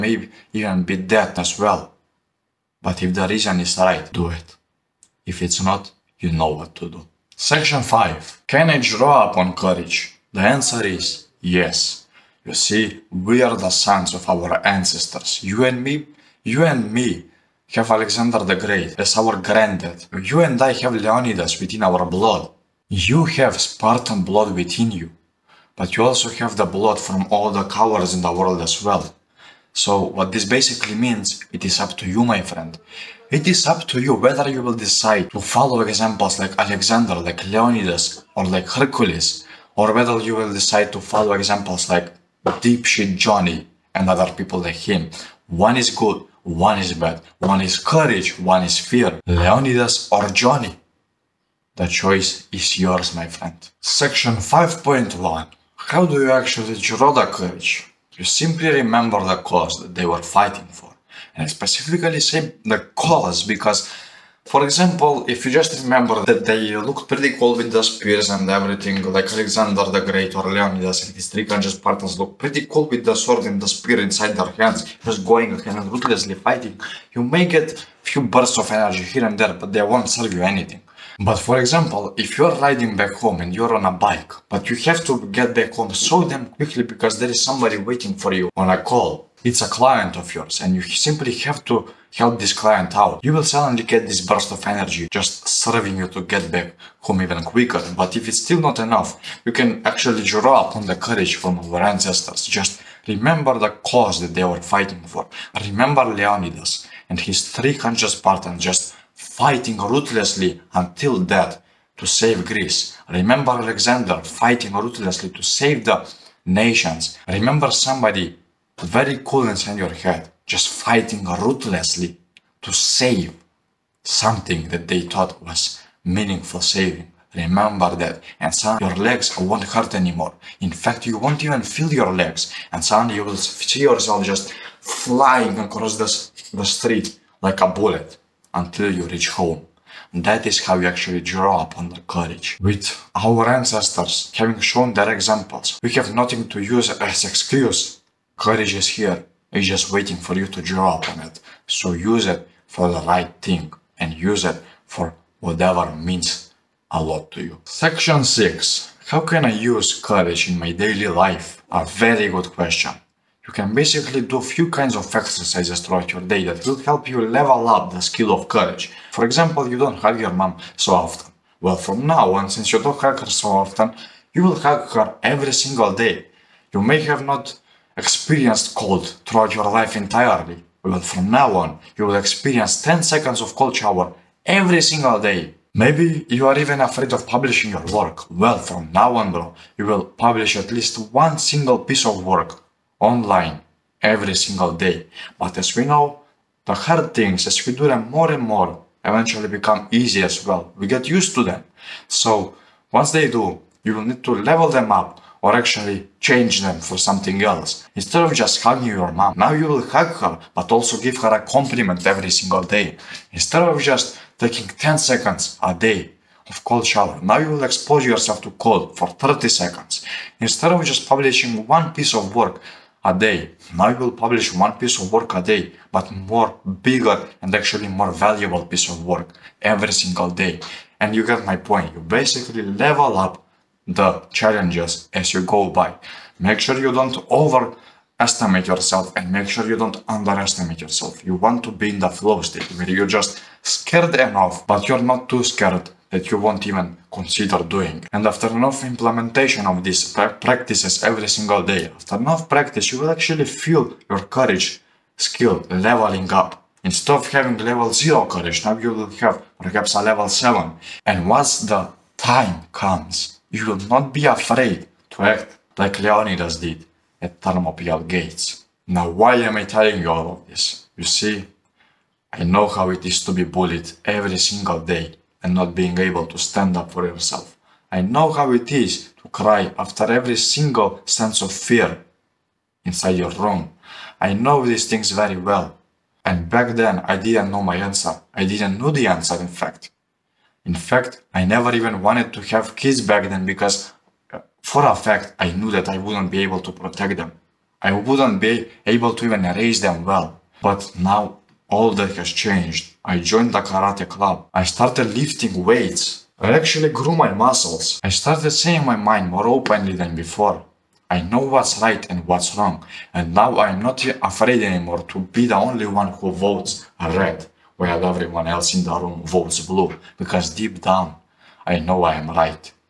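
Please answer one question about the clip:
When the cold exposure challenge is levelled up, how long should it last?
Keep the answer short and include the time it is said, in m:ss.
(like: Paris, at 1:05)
30 seconds, at 3:39.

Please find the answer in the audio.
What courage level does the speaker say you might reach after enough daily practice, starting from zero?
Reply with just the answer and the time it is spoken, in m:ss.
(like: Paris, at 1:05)
7, at 4:20.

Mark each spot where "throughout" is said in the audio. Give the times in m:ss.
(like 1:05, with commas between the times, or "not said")
2:45, 2:59.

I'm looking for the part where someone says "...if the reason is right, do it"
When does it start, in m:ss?
0:03.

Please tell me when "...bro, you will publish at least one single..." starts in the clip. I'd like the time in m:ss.
3:09.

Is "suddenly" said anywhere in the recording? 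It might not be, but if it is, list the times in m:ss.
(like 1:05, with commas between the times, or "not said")
1:33, 2:08, 2:12.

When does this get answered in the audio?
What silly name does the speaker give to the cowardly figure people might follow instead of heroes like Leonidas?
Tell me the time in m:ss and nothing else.
0:42.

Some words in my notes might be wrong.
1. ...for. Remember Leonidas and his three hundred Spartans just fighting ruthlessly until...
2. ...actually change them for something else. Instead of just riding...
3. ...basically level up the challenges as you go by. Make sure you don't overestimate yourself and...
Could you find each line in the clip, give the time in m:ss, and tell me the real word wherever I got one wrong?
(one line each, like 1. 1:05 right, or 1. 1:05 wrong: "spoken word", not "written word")
1. 1:45 right
2. 3:25 wrong: "hugging", not "riding"
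3. 3:51 right.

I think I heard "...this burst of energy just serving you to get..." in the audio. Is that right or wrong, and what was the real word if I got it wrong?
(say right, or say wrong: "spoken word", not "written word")
right.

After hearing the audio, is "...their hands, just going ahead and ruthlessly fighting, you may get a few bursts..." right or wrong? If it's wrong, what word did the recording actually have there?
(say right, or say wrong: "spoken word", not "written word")
right.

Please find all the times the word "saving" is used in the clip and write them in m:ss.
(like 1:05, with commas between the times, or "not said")
2:06.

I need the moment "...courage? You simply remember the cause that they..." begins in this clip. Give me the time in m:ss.
0:57.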